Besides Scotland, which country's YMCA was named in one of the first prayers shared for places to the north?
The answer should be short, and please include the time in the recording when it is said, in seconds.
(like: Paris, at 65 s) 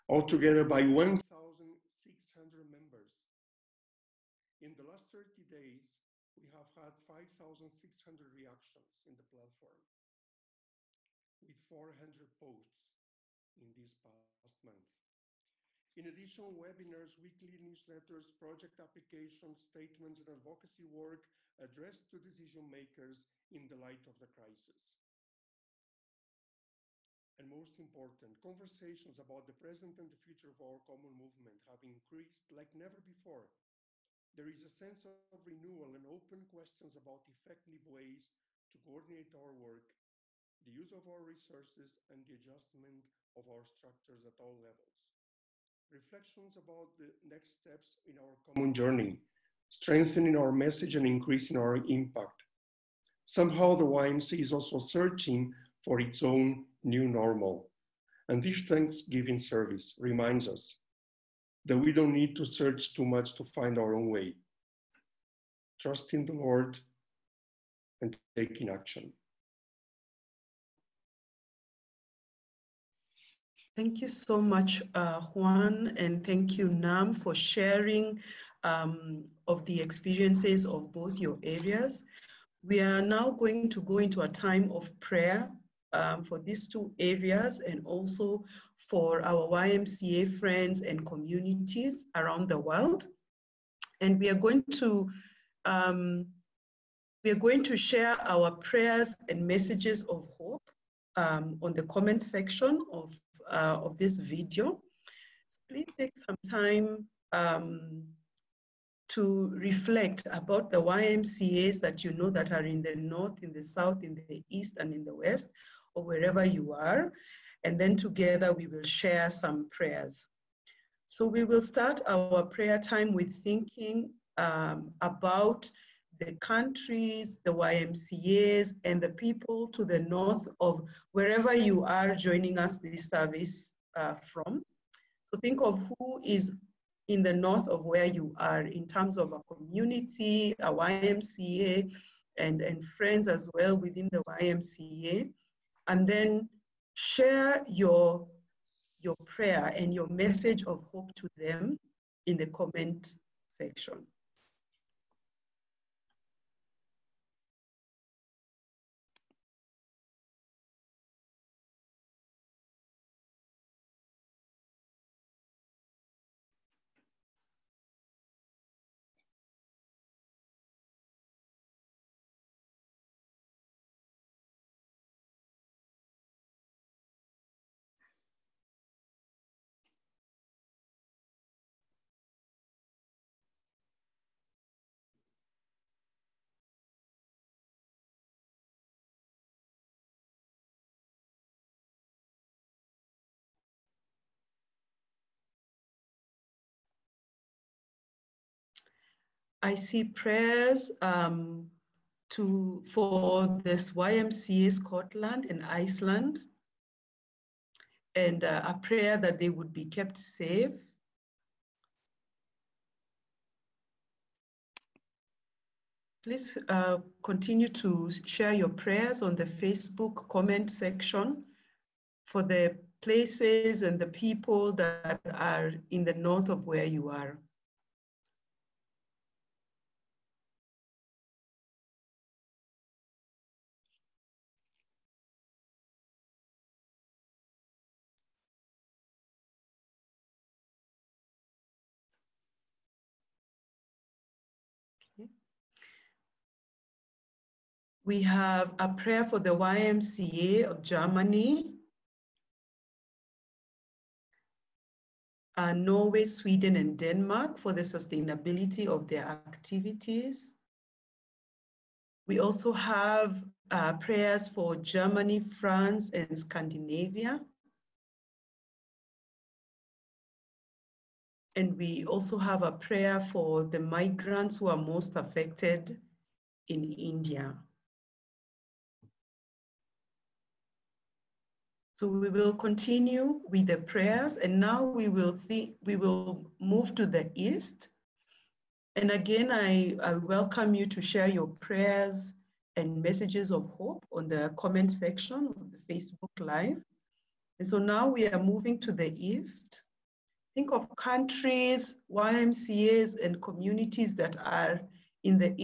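Iceland, at 205 s.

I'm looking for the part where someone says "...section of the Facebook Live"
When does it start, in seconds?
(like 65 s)
294 s.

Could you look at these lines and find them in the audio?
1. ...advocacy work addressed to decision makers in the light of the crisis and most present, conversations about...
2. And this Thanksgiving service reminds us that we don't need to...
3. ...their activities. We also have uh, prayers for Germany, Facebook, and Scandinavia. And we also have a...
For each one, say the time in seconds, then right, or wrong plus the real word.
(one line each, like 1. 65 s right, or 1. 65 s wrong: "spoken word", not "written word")
1. 20 s wrong: "important", not "present"
2. 58 s right
3. 259 s wrong: "France", not "Facebook".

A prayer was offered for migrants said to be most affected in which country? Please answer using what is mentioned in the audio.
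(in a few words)
India.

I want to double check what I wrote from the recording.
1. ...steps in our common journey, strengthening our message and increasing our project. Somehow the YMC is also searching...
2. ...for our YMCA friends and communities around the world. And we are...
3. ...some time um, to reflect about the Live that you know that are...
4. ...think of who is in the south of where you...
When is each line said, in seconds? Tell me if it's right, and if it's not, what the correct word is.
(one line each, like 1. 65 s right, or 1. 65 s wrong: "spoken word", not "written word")
1. 47 s wrong: "impact", not "project"
2. 88 s right
3. 106 s wrong: "YMCAs", not "Live"
4. 135 s wrong: "north", not "south".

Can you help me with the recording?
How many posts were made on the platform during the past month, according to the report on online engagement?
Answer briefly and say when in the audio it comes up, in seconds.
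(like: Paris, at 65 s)
400, at 11 s.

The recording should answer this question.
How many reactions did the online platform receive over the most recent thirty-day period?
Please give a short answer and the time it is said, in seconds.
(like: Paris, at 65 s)
5,600, at 7 s.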